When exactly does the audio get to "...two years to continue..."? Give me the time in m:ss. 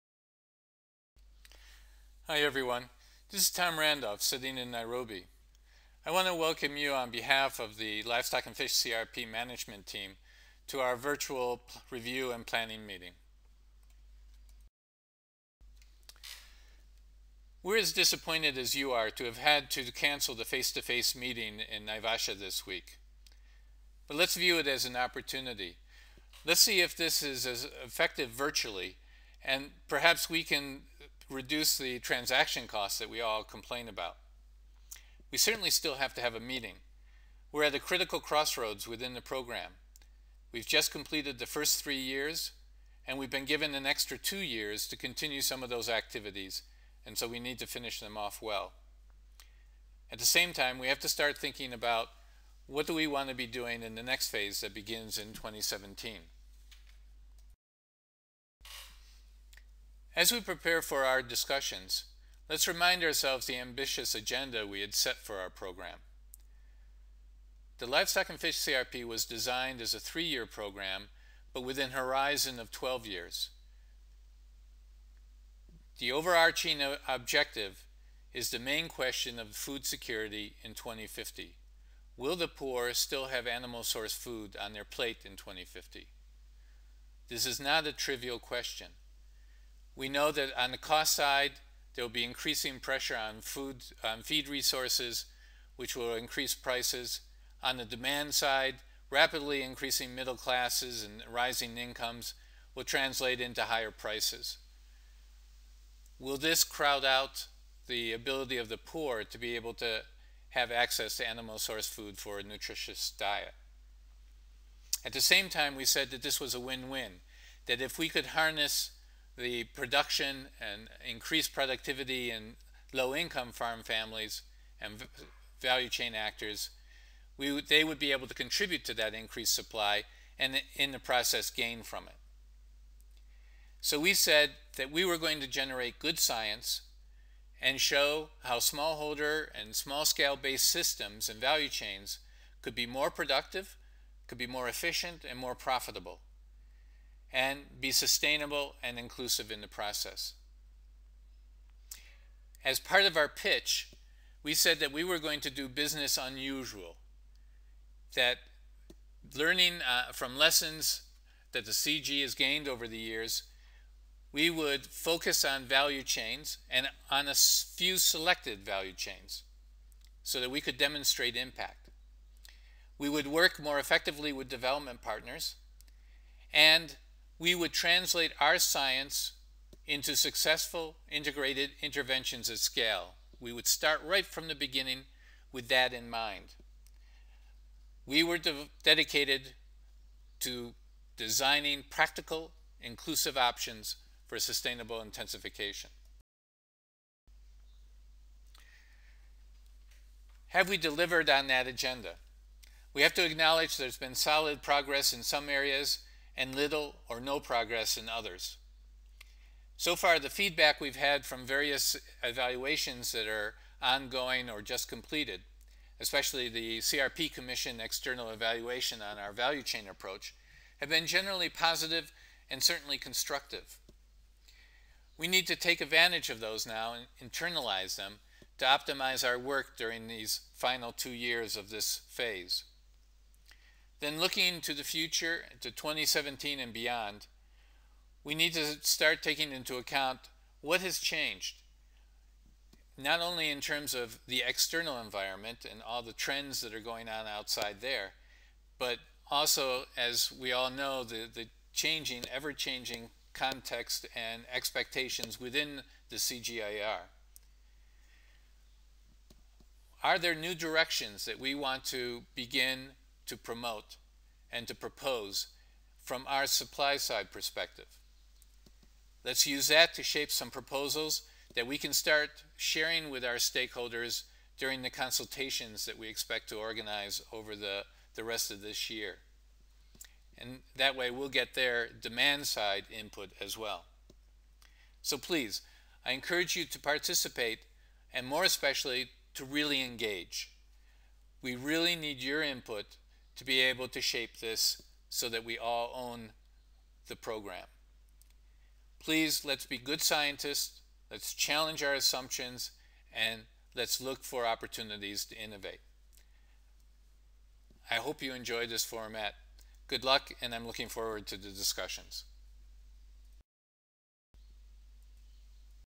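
0:44.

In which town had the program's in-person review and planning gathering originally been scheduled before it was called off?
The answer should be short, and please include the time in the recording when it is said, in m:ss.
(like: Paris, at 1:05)
Naivasha, at 0:21.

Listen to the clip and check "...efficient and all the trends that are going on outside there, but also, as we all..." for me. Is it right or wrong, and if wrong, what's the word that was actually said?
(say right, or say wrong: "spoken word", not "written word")
wrong: "environment", not "efficient".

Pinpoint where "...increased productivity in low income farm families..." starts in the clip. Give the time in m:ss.
2:01.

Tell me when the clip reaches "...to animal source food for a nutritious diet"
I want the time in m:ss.
1:51.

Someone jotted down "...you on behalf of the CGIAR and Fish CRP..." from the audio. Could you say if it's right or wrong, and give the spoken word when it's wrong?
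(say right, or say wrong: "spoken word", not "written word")
wrong: "Livestock", not "CGIAR".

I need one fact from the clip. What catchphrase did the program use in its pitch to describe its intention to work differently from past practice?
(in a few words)
business unusual.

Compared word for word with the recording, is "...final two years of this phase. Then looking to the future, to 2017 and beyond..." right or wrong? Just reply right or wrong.
right.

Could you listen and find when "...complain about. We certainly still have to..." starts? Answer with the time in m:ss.
0:33.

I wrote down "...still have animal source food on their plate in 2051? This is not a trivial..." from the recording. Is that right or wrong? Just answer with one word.
wrong.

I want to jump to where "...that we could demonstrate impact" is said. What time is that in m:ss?
2:50.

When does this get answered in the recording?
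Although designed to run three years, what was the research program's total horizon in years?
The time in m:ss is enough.
1:12.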